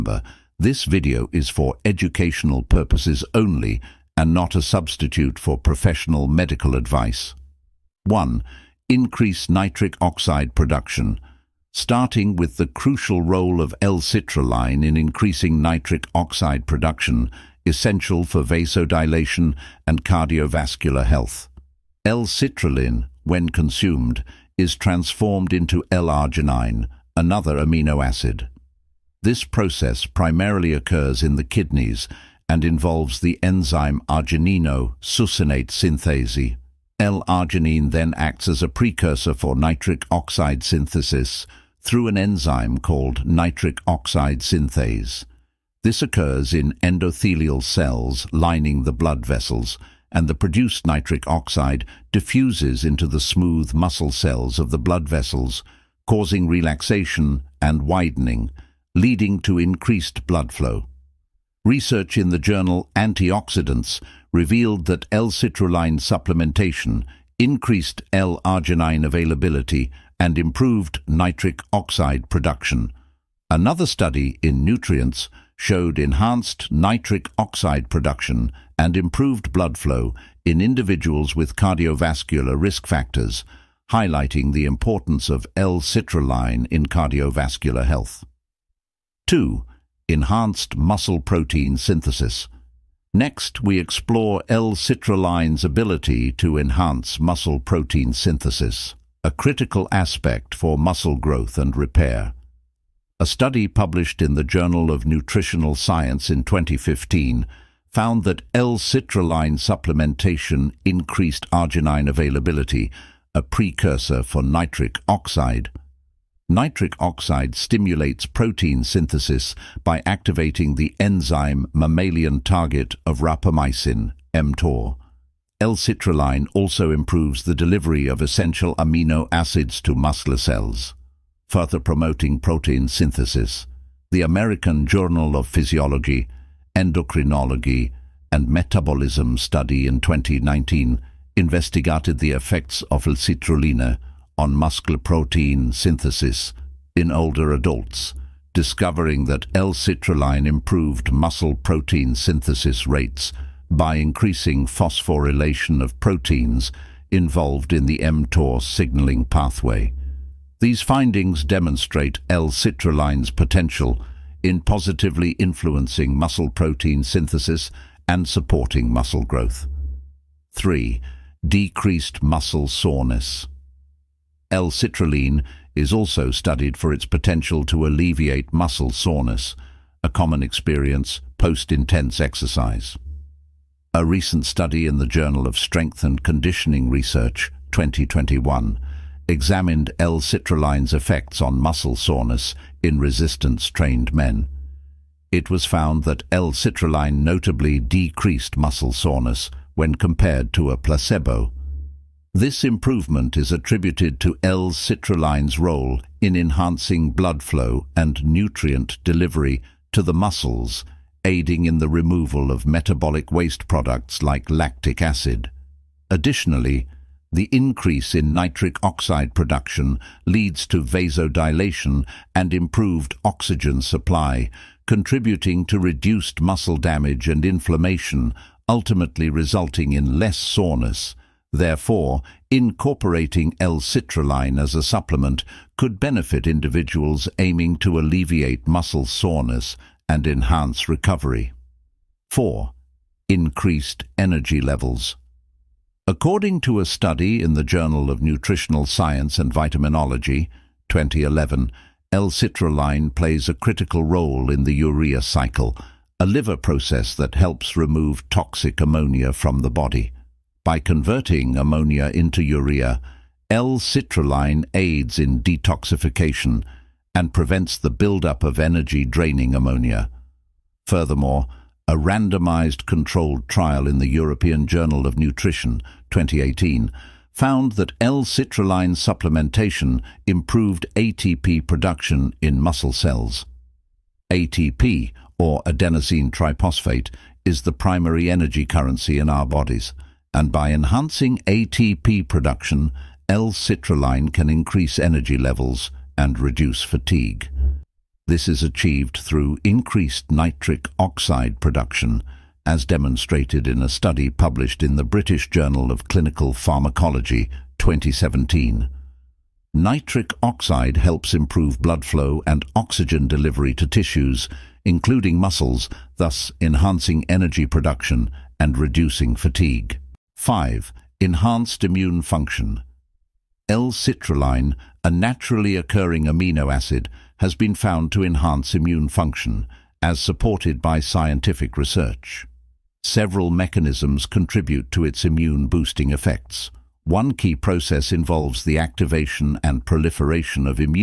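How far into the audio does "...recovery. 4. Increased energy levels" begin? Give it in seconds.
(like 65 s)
240 s.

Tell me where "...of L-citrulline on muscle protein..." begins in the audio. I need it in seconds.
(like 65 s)
142 s.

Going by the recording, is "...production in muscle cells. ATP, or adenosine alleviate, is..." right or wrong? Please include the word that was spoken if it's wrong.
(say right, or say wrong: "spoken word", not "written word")
wrong: "triphosphate", not "alleviate".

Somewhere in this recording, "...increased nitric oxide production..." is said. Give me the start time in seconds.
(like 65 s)
299 s.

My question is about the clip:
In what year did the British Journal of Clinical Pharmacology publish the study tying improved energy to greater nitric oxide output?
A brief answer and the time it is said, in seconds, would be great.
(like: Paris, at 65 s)
2017, at 307 s.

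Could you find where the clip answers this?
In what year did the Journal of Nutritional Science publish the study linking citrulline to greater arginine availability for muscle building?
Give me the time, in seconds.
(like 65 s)
106 s.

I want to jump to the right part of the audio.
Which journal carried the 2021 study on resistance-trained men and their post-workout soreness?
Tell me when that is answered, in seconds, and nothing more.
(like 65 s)
185 s.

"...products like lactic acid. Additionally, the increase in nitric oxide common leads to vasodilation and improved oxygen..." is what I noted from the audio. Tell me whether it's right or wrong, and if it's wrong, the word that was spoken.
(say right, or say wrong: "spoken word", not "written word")
wrong: "production", not "common".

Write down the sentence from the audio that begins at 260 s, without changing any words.
By converting ammonia into urea, L-citrulline aids in detoxification and prevents the buildup of energy-draining ammonia.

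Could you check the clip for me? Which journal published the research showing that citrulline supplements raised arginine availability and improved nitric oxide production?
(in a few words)
Antioxidants.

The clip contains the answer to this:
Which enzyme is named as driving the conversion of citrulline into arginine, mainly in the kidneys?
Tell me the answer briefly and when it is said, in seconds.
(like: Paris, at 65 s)
arginino-succinate synthase, at 34 s.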